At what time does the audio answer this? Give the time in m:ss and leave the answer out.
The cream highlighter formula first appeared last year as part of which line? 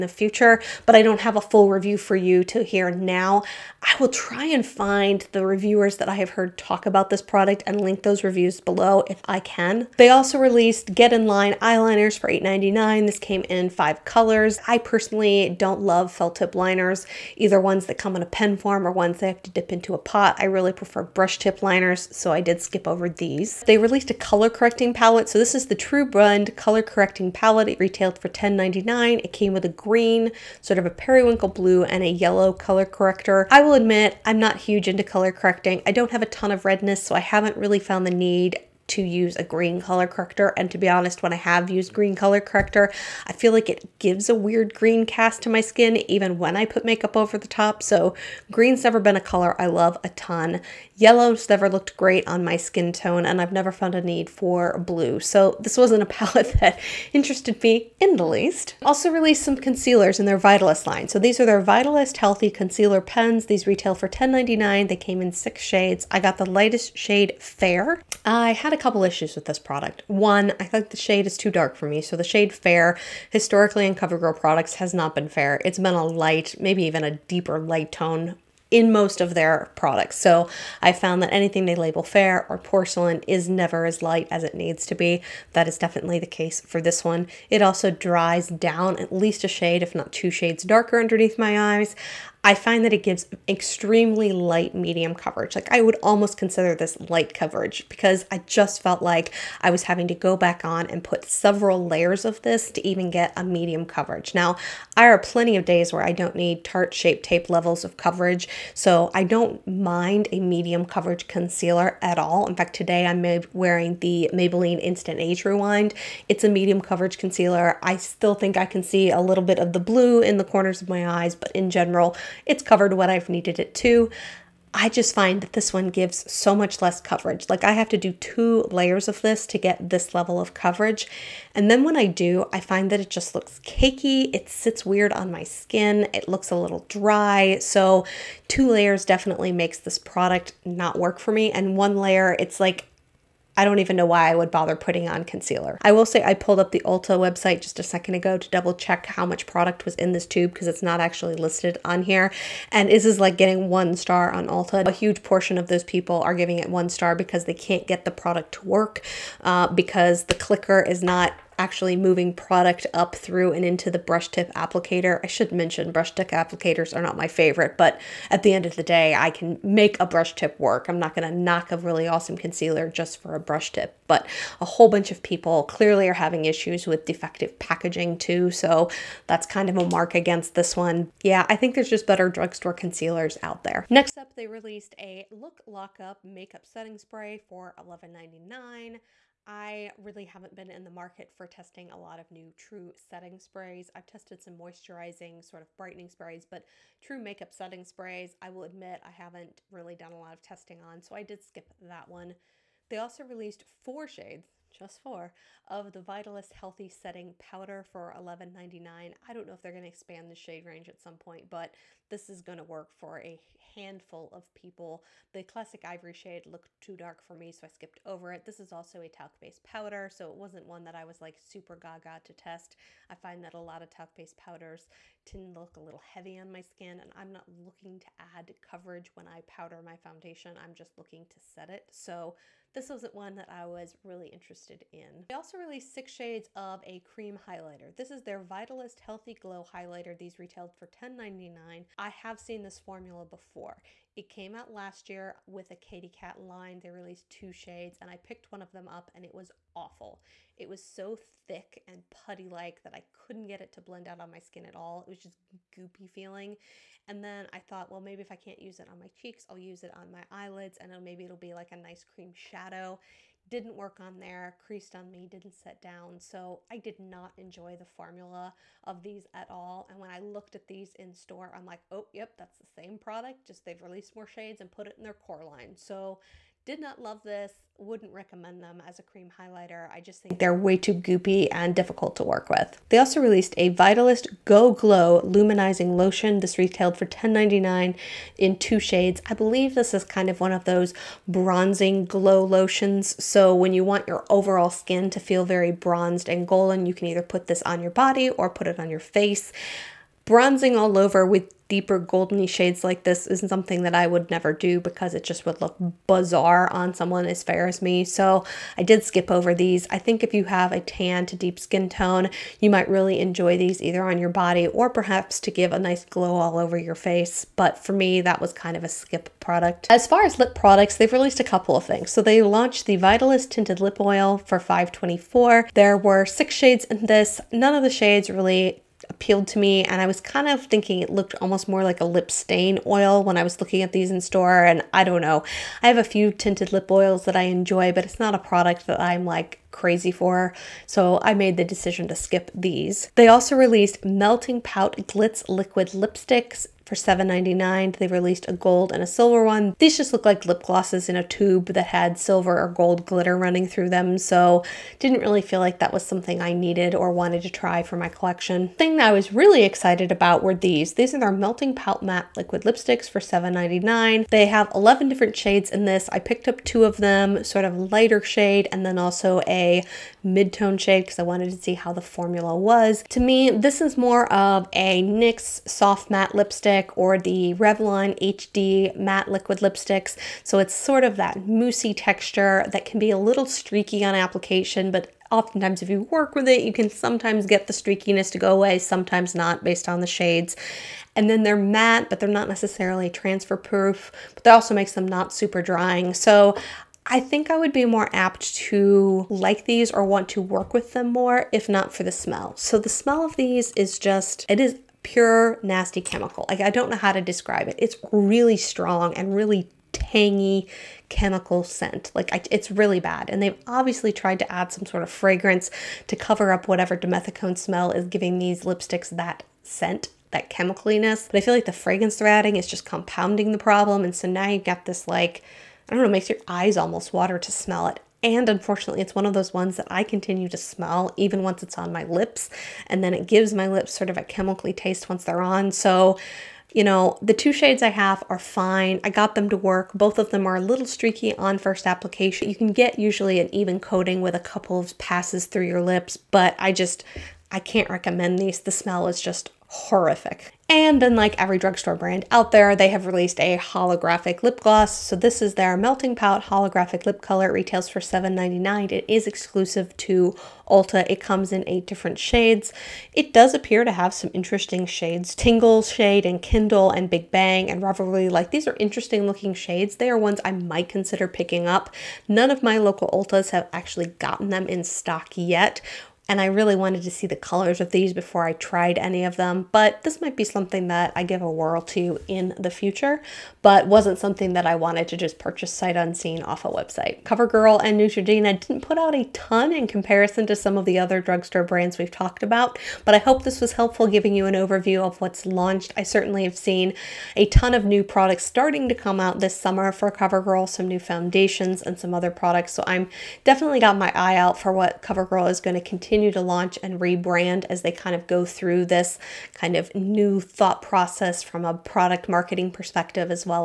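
4:05.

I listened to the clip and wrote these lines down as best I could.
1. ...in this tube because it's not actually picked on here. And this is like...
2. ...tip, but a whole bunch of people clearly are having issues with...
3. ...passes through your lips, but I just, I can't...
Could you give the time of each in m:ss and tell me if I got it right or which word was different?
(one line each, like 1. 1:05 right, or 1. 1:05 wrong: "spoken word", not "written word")
1. 2:29 wrong: "listed", not "picked"
2. 2:53 right
3. 7:24 right.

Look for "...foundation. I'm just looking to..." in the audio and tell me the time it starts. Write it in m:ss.
3:49.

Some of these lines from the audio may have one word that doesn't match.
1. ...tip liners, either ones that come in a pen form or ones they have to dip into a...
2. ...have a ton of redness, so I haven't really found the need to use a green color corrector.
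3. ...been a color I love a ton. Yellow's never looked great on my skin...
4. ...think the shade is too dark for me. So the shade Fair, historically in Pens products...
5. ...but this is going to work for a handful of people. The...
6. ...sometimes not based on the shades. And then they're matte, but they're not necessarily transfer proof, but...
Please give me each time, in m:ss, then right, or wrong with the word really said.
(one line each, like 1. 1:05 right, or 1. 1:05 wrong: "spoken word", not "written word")
1. 0:16 right
2. 0:36 right
3. 0:48 right
4. 1:10 wrong: "CoverGirl", not "Pens"
5. 3:31 right
6. 6:28 right.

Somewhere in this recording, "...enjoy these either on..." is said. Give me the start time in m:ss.
5:13.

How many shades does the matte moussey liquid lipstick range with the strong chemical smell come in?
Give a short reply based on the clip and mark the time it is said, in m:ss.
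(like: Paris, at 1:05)
11, at 6:04.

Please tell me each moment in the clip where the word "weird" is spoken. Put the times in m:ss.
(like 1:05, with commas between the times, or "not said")
0:44, 2:14.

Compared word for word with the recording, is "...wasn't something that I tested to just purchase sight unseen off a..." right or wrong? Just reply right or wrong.
wrong.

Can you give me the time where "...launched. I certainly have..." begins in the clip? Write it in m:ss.
8:15.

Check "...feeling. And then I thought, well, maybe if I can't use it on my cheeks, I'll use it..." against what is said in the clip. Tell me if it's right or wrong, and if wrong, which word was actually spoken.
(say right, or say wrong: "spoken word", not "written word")
right.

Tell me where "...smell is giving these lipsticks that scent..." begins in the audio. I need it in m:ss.
6:57.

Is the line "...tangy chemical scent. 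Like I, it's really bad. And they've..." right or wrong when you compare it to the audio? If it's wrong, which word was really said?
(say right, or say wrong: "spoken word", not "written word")
right.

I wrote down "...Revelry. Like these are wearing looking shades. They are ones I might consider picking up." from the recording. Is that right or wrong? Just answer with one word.
wrong.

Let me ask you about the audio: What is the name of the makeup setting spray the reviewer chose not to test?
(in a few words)
Look Lock Up.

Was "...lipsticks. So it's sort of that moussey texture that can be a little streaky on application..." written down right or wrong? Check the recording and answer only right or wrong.
right.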